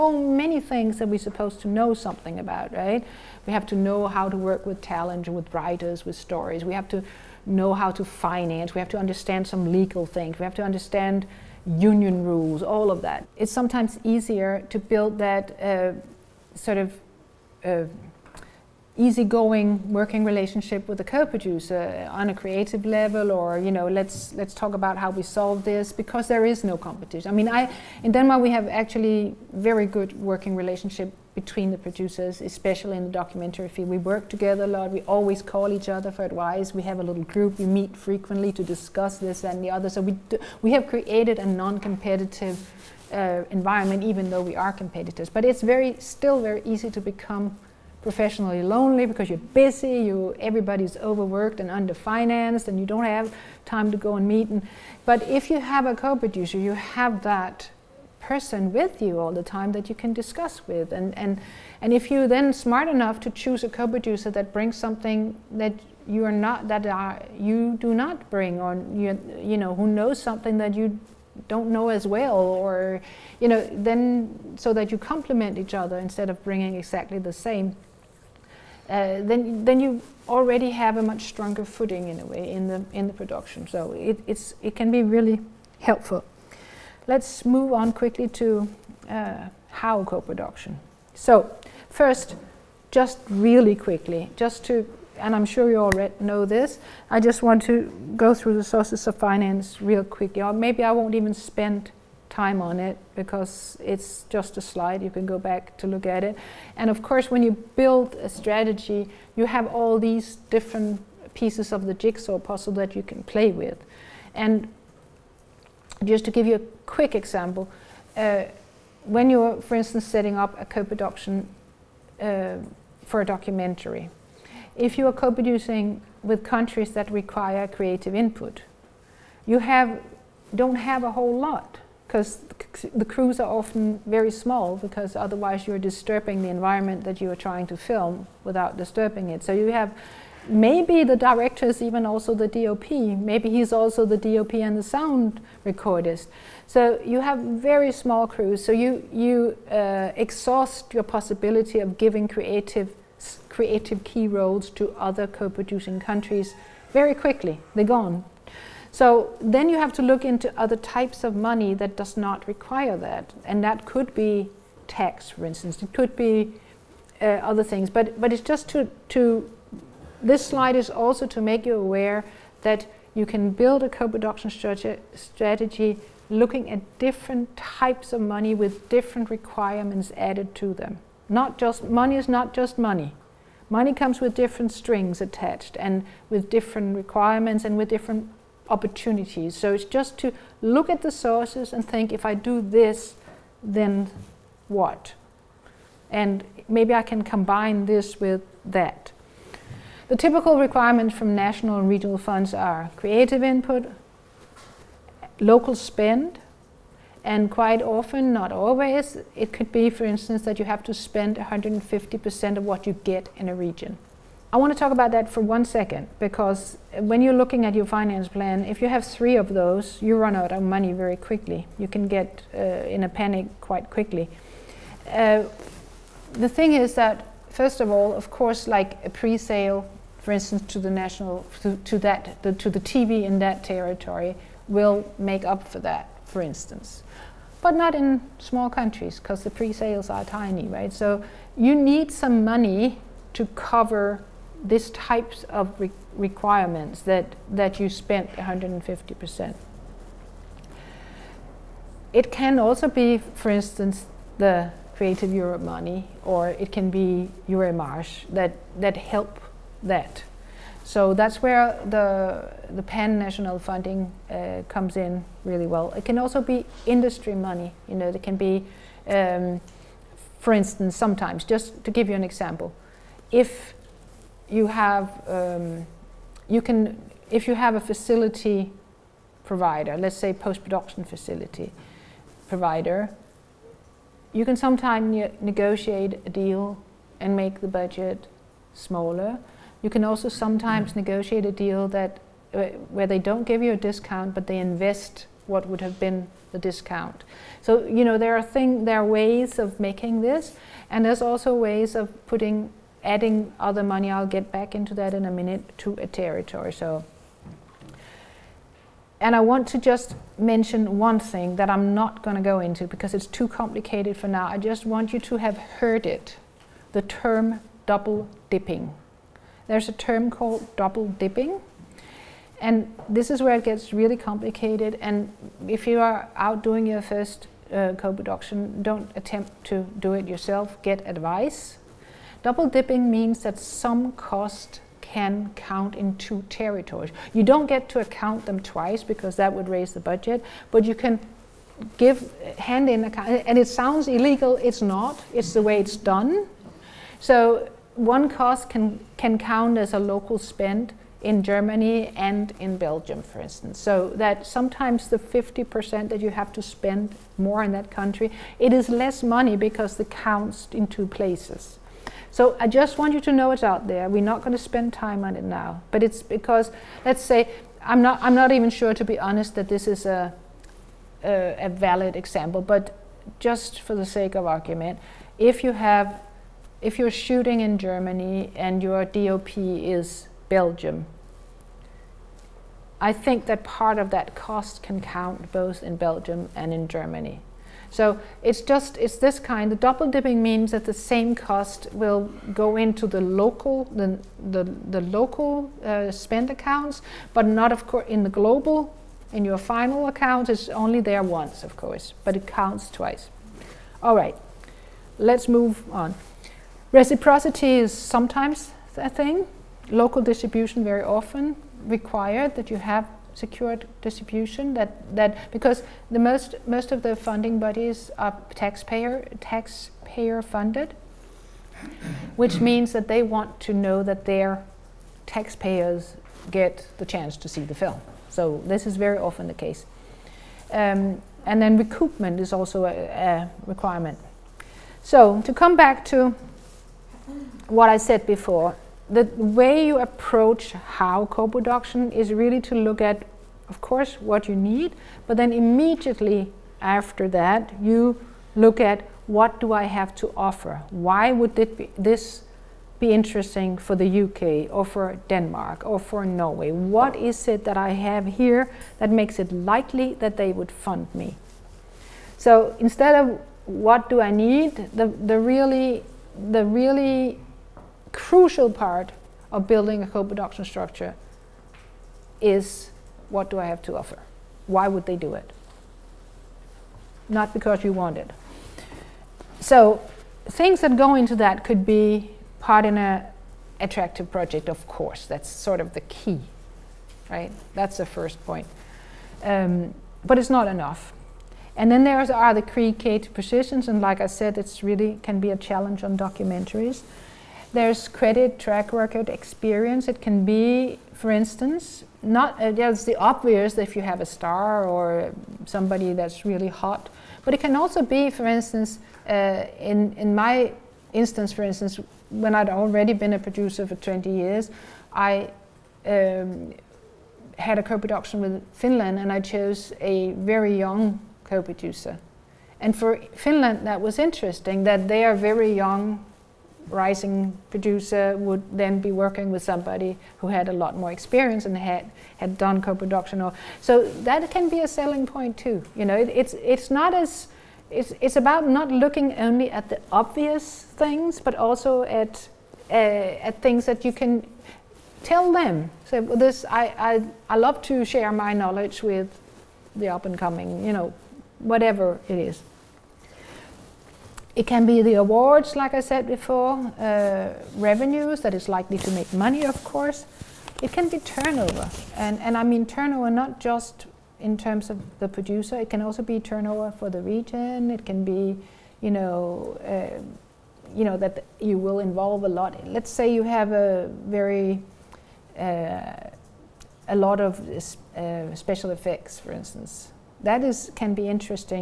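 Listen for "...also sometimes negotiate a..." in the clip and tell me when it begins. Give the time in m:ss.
4:50.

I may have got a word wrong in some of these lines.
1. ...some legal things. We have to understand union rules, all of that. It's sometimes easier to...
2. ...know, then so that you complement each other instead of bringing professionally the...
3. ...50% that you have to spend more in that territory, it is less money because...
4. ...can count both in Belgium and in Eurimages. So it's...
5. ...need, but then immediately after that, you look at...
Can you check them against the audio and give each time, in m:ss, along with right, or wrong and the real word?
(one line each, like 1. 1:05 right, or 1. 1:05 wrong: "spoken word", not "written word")
1. 0:09 right
2. 1:13 wrong: "exactly", not "professionally"
3. 5:55 wrong: "country", not "territory"
4. 6:24 wrong: "Germany", not "Eurimages"
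5. 7:24 right.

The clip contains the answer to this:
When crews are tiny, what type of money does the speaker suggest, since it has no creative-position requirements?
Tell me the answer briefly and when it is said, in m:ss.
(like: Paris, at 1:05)
Tax, at 2:44.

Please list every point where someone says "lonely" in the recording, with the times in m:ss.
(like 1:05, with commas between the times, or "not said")
0:48.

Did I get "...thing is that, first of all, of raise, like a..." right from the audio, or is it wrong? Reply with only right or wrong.
wrong.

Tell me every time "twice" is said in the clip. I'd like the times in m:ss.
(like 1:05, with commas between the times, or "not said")
5:38, 6:42.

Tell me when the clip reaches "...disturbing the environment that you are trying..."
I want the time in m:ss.
2:15.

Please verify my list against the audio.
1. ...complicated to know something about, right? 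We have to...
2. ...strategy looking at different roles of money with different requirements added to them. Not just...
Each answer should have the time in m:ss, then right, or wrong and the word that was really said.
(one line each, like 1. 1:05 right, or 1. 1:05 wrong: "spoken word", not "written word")
1. 0:01 wrong: "supposed", not "complicated"
2. 2:55 wrong: "types", not "roles".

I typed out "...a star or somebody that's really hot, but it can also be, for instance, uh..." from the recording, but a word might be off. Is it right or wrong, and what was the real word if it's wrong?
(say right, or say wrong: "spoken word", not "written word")
right.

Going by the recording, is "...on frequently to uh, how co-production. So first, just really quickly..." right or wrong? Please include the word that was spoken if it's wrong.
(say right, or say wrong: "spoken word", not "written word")
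wrong: "quickly", not "frequently".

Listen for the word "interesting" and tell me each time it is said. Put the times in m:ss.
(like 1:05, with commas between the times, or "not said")
7:33, 8:44, 9:41.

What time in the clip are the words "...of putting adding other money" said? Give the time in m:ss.
5:01.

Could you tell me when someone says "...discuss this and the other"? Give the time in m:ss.
0:38.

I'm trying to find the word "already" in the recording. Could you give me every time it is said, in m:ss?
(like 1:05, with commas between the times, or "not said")
1:20, 8:32.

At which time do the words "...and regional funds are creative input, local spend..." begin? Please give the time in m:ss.
3:21.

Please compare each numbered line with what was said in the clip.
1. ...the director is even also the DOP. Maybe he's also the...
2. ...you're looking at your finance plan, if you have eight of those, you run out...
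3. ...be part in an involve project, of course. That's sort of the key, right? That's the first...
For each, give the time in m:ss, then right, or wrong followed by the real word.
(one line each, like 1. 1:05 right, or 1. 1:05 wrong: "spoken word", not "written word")
1. 2:21 right
2. 3:37 wrong: "three", not "eight"
3. 8:01 wrong: "attractive", not "involve".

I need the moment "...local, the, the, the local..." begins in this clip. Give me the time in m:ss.
6:33.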